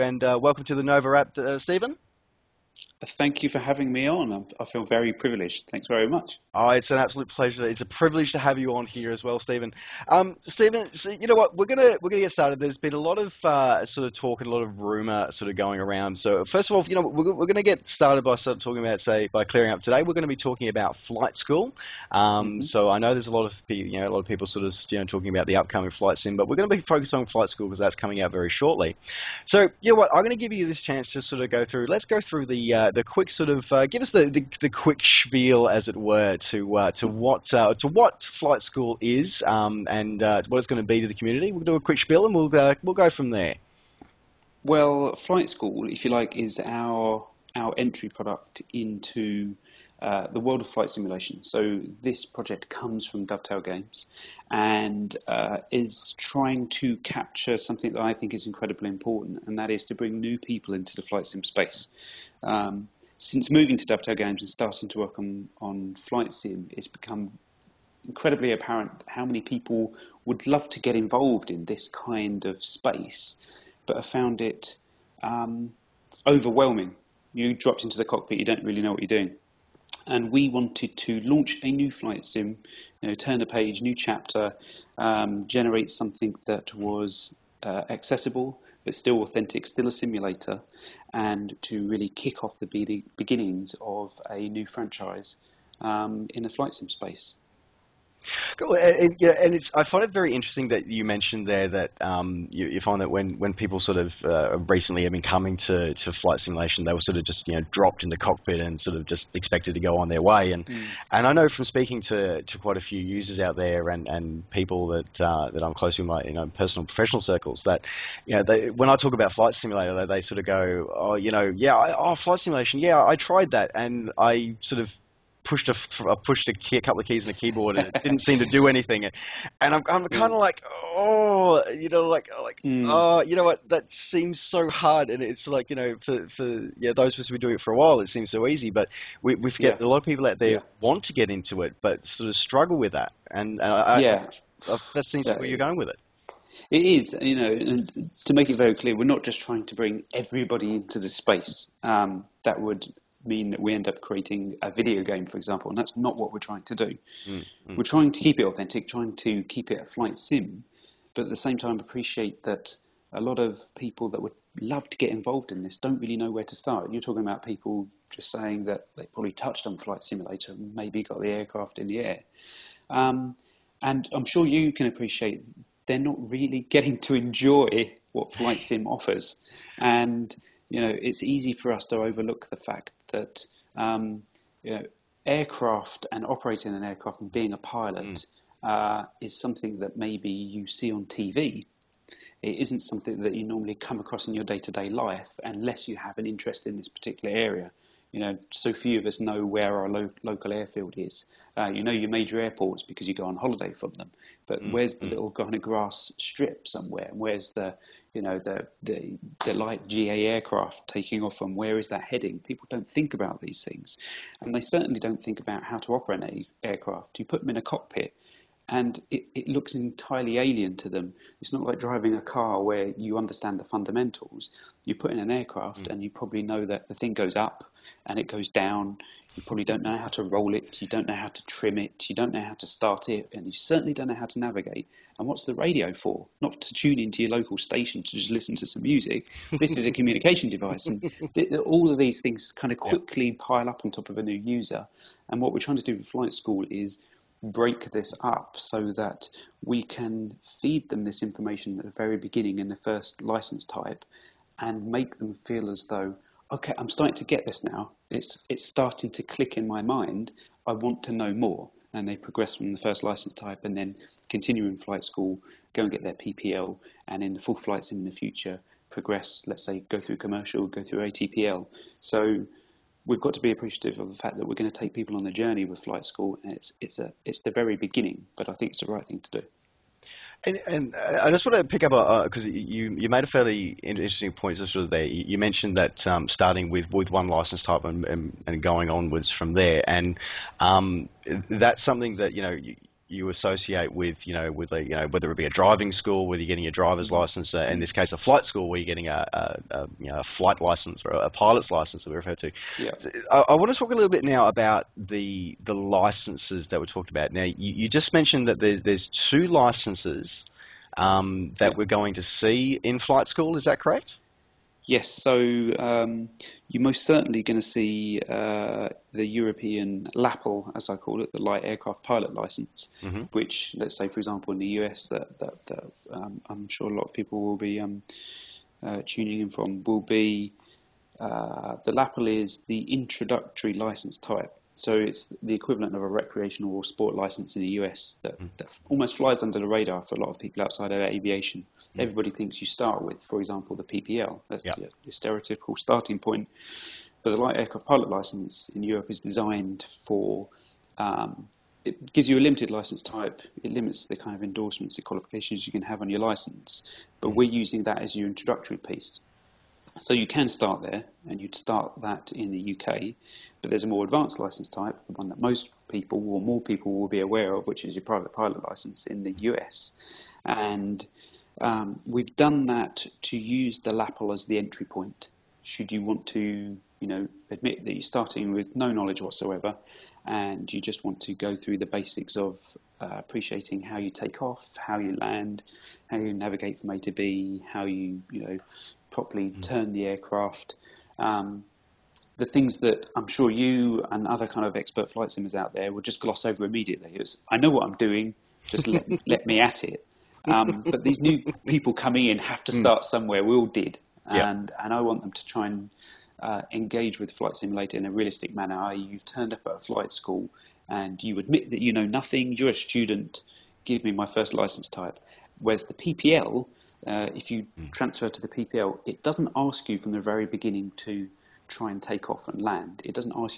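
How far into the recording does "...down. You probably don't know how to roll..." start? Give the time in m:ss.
3:48.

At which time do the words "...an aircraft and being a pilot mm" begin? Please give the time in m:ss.
3:06.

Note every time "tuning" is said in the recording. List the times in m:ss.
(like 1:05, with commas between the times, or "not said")
5:29.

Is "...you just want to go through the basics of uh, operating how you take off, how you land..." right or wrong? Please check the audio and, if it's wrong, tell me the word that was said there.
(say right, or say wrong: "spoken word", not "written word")
wrong: "appreciating", not "operating".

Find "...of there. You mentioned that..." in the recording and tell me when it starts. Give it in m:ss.
4:44.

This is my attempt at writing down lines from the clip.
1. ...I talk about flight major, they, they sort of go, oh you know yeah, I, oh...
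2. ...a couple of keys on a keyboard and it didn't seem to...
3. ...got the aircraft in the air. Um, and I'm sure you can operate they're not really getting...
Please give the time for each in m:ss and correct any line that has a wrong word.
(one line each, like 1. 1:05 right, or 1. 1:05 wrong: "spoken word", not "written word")
1. 1:58 wrong: "simulator", not "major"
2. 2:06 right
3. 2:51 wrong: "appreciate", not "operate".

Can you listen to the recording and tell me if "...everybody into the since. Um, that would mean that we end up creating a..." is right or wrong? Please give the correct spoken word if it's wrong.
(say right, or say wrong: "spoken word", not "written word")
wrong: "space", not "since".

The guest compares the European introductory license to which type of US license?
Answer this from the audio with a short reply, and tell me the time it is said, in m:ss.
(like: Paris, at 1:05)
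recreational or sport license, at 5:36.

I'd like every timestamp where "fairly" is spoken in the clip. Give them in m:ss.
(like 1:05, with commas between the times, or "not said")
4:43.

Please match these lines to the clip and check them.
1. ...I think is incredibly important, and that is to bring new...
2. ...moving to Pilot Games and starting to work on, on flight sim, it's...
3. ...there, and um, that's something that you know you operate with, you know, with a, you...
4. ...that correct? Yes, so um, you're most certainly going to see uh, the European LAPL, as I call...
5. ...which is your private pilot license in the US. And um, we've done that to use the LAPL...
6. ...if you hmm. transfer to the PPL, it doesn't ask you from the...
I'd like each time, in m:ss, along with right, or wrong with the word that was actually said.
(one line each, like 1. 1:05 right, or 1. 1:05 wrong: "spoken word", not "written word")
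1. 0:58 right
2. 1:03 wrong: "Dovetail", not "Pilot"
3. 4:49 wrong: "associate", not "operate"
4. 5:13 right
5. 6:07 right
6. 6:57 right.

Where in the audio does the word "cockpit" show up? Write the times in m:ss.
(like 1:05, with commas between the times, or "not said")
1:18, 1:48, 3:37.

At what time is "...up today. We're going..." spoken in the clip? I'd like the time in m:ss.
0:19.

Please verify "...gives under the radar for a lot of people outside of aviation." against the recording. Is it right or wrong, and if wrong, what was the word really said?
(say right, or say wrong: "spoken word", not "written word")
wrong: "flies", not "gives".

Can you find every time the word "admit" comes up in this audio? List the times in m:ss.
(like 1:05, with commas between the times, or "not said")
6:17, 6:51.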